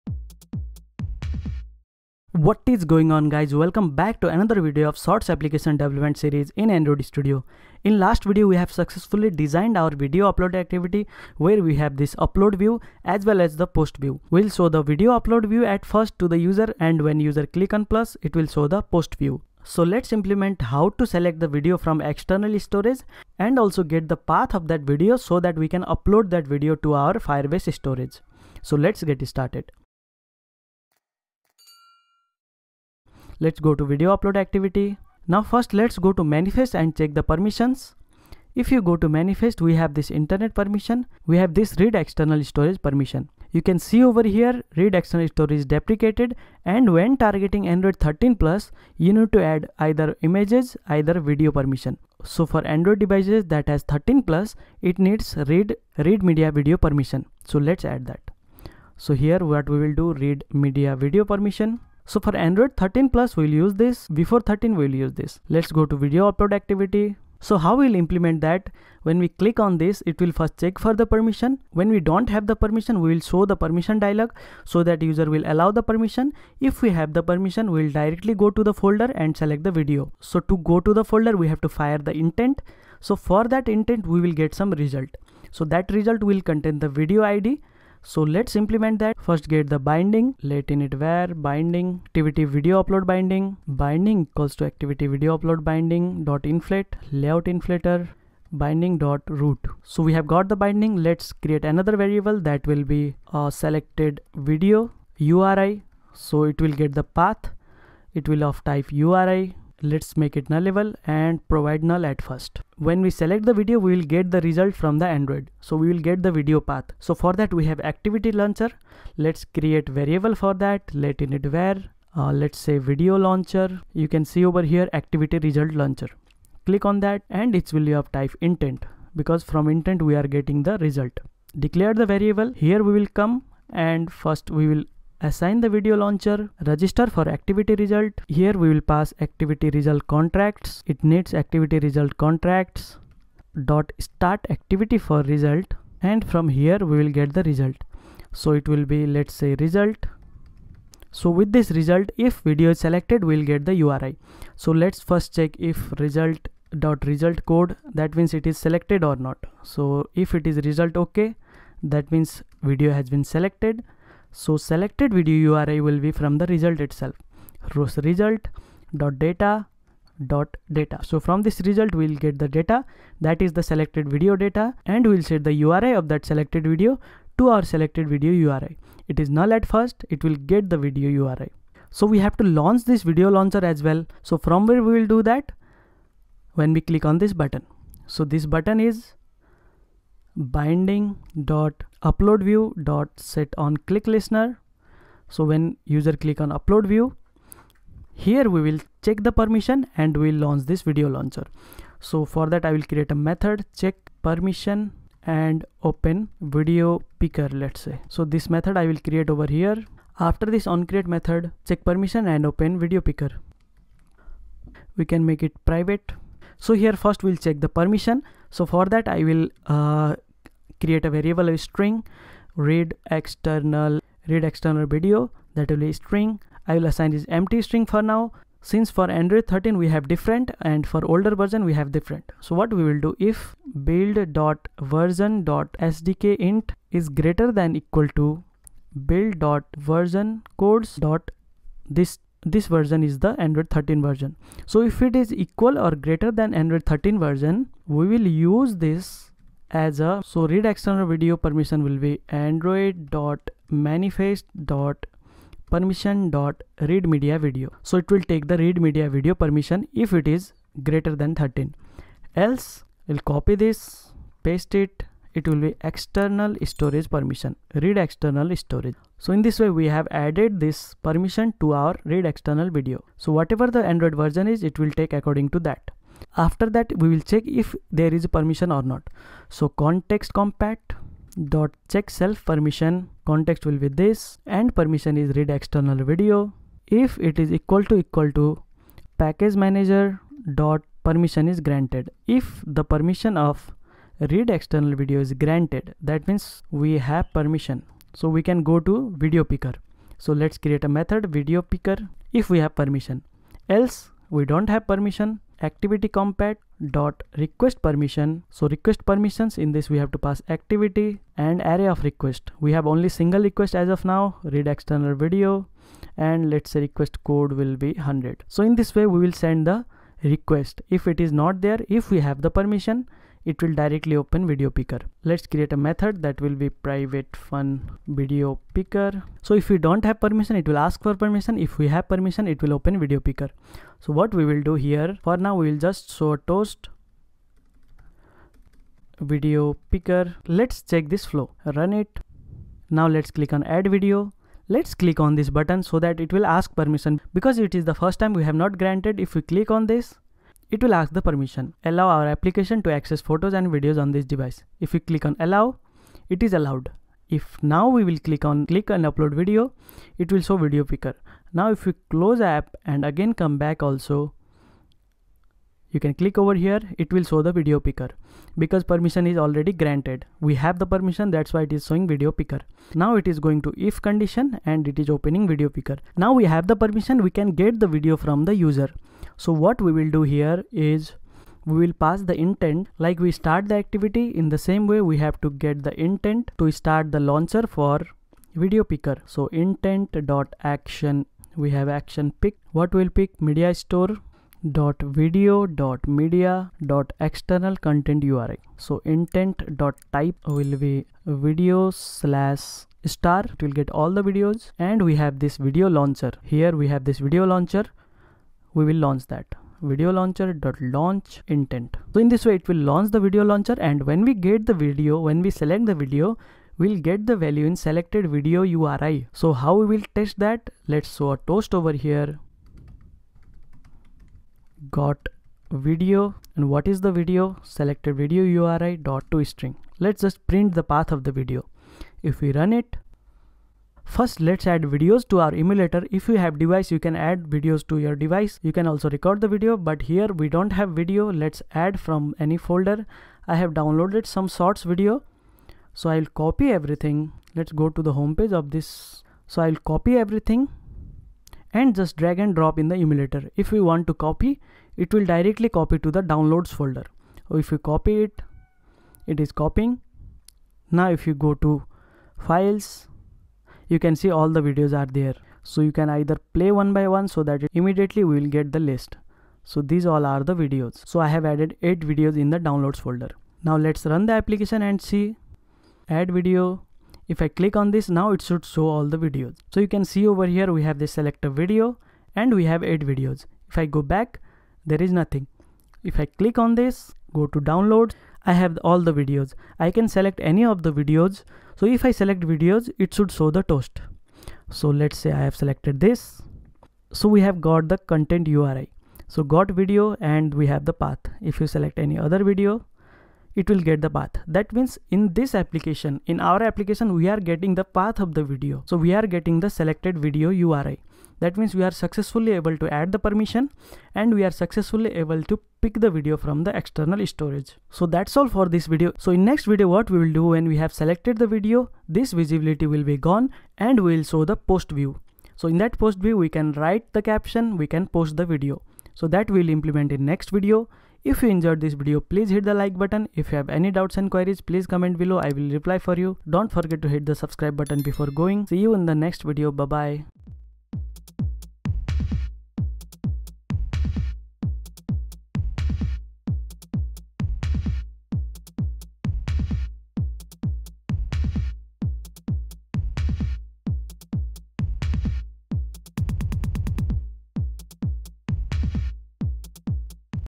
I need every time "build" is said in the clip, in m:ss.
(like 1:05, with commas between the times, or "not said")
3:53, 3:59.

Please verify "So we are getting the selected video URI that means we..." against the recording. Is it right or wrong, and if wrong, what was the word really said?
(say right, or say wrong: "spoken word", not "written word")
right.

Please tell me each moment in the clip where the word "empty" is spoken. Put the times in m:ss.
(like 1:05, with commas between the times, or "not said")
3:47.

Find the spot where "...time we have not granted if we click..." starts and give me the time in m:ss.
5:48.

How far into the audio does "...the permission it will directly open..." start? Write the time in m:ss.
5:22.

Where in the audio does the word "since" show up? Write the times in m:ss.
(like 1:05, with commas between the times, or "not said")
3:48.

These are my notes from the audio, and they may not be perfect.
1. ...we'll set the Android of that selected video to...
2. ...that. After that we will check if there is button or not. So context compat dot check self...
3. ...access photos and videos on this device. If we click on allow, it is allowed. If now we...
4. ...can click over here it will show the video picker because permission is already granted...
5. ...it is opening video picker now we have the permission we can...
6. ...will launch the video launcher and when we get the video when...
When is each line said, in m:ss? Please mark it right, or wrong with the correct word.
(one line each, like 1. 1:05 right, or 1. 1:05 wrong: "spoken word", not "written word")
1. 2:55 wrong: "URI", not "Android"
2. 4:35 wrong: "permission", not "button"
3. 5:52 right
4. 6:05 right
5. 6:14 right
6. 6:52 right.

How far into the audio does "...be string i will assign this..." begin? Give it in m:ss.
3:45.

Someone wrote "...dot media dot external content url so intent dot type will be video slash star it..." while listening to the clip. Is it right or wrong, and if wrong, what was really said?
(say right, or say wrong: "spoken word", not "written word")
right.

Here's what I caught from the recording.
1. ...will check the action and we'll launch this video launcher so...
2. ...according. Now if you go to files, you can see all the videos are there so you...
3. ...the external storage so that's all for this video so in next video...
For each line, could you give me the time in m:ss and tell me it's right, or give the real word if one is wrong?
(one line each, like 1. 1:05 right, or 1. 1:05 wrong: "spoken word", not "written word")
1. 3:18 wrong: "permission", not "action"
2. 7:39 wrong: "copying", not "according"
3. 8:36 right.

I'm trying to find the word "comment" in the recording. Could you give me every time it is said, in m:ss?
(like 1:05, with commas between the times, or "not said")
8:54.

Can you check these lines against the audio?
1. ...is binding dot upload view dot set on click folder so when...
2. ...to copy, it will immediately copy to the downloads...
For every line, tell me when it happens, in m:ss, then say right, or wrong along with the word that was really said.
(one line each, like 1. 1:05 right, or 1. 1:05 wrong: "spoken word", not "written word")
1. 3:08 wrong: "listener", not "folder"
2. 7:34 wrong: "directly", not "immediately".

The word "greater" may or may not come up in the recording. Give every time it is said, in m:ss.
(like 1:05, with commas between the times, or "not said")
3:57, 4:05, 4:20.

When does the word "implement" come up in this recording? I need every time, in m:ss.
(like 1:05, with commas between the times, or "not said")
0:20, 1:07, 1:28, 8:49.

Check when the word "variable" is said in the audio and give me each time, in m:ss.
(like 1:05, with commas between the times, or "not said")
1:41, 1:59, 2:12, 3:41.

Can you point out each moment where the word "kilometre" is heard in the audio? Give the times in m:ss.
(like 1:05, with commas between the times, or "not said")
not said.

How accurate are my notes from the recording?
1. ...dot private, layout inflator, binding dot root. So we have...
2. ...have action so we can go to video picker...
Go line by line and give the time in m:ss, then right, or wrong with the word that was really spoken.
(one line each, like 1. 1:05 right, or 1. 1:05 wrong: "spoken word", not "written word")
1. 1:36 wrong: "inflate", not "private"
2. 4:56 wrong: "permission", not "action".